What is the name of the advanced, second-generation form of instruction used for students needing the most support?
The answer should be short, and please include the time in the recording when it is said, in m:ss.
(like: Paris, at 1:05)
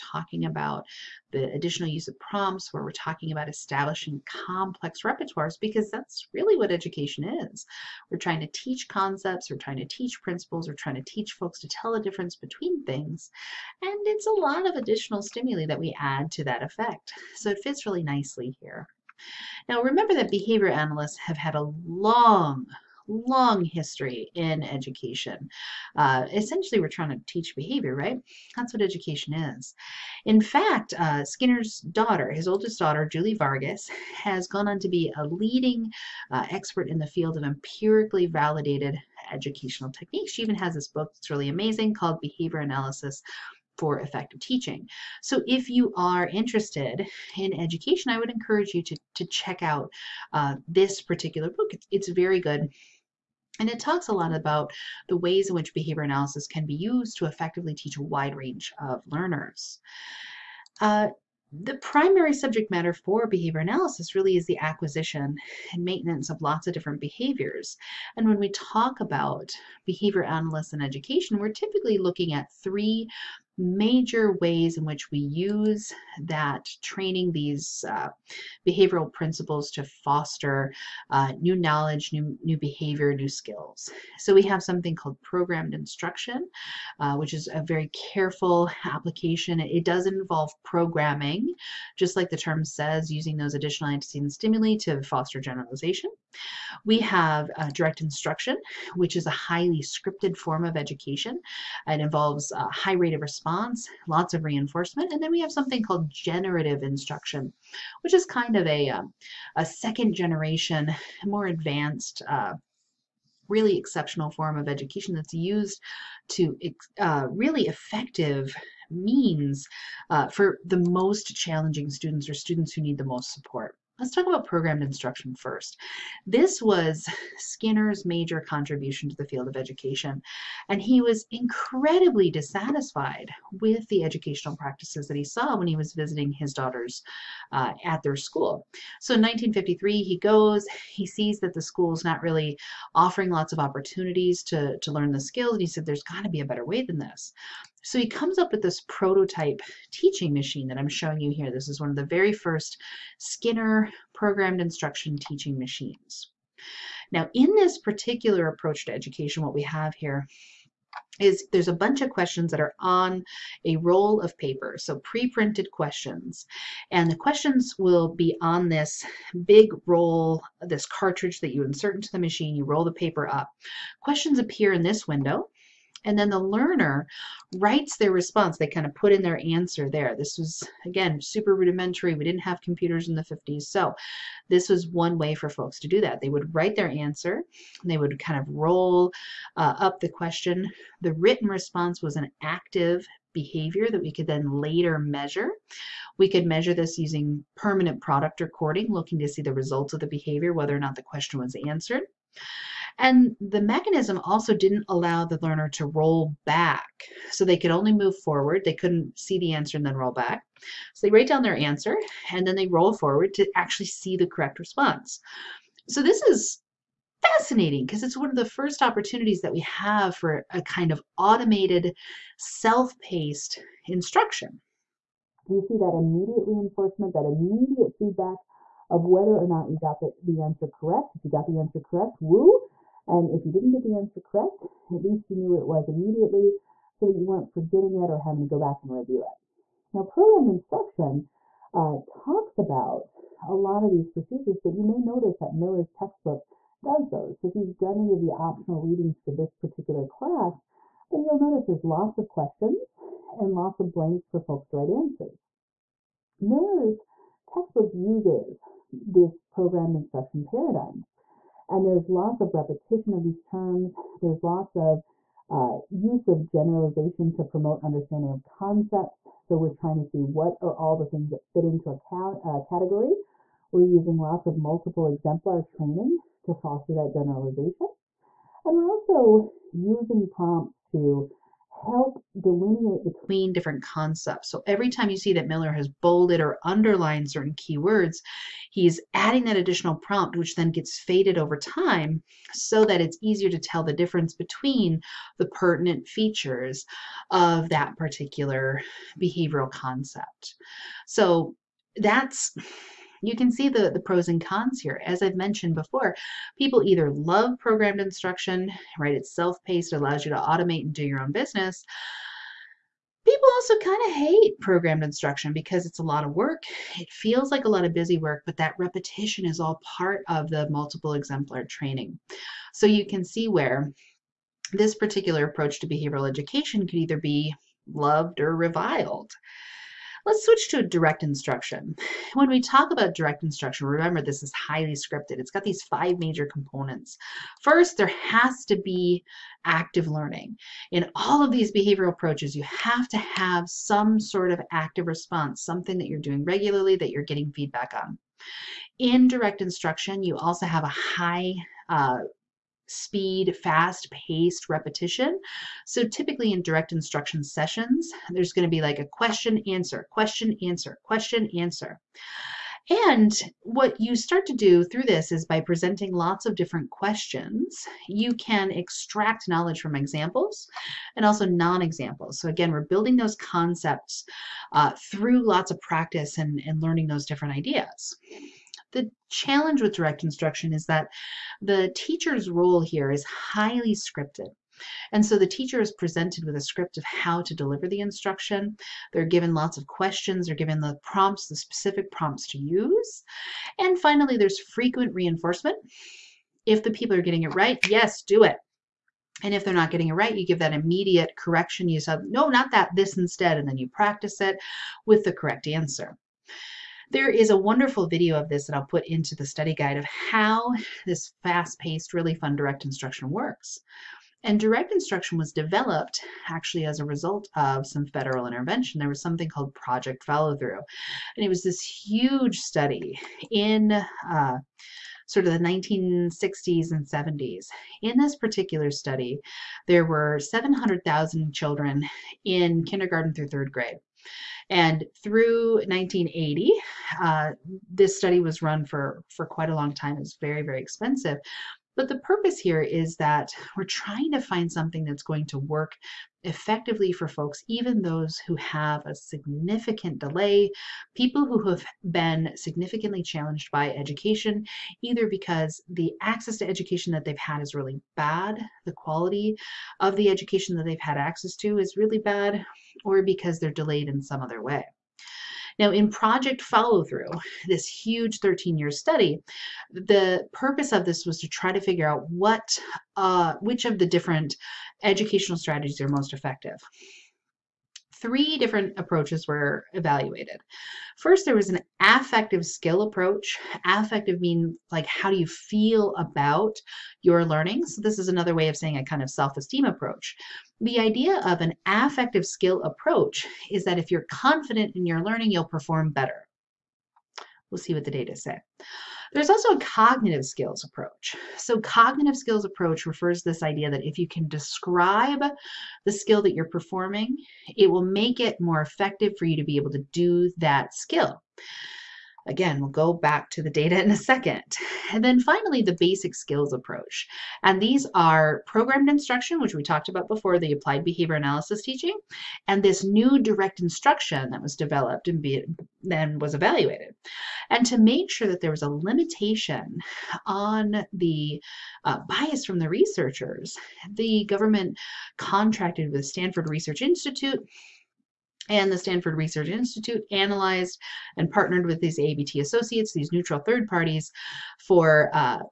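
generative instruction, at 1:46.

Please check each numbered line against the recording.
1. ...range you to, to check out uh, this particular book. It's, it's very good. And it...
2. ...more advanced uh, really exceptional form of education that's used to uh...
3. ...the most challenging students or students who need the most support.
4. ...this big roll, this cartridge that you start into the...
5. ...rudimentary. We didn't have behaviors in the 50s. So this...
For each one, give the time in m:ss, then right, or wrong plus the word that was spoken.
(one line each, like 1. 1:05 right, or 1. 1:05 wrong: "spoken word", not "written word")
1. 0:48 wrong: "encourage", not "range"
2. 1:51 right
3. 2:00 right
4. 2:48 wrong: "insert", not "start"
5. 3:01 wrong: "computers", not "behaviors".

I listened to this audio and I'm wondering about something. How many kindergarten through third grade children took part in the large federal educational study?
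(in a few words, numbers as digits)
700,000.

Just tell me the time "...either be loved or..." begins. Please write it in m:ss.
5:26.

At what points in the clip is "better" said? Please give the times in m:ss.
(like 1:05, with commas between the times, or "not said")
2:26, 8:16.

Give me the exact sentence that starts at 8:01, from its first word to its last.
First, there was an affective skill approach.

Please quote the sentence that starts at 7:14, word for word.
And through 1980, uh, this study was run for, for quite a long time.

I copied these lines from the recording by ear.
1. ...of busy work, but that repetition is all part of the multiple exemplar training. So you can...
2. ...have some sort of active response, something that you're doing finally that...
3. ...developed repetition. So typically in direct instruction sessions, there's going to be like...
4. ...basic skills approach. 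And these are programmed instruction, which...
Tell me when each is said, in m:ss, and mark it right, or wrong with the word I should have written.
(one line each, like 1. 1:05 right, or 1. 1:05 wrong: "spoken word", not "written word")
1. 5:17 right
2. 5:43 wrong: "regularly", not "finally"
3. 5:54 wrong: "paced", not "developed"
4. 8:35 right.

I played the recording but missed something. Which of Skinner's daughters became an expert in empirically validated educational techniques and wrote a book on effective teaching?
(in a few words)
Julie Vargas.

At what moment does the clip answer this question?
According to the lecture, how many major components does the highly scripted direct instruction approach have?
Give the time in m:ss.
5:35.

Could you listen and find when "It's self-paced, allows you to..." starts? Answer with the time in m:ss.
5:09.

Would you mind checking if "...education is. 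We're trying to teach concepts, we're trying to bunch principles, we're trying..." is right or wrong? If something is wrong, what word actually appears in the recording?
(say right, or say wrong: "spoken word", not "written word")
wrong: "teach", not "bunch".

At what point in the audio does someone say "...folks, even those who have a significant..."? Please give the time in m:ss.
7:27.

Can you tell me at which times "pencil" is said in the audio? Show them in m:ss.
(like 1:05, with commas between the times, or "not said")
not said.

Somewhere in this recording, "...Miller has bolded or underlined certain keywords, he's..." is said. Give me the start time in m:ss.
4:45.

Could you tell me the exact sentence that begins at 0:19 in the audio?
Now remember that behavior analysts have had a long long history in education.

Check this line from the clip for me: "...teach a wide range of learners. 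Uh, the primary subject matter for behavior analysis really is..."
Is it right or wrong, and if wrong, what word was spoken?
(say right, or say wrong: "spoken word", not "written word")
right.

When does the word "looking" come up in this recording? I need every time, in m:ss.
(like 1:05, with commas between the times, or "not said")
1:11, 3:18.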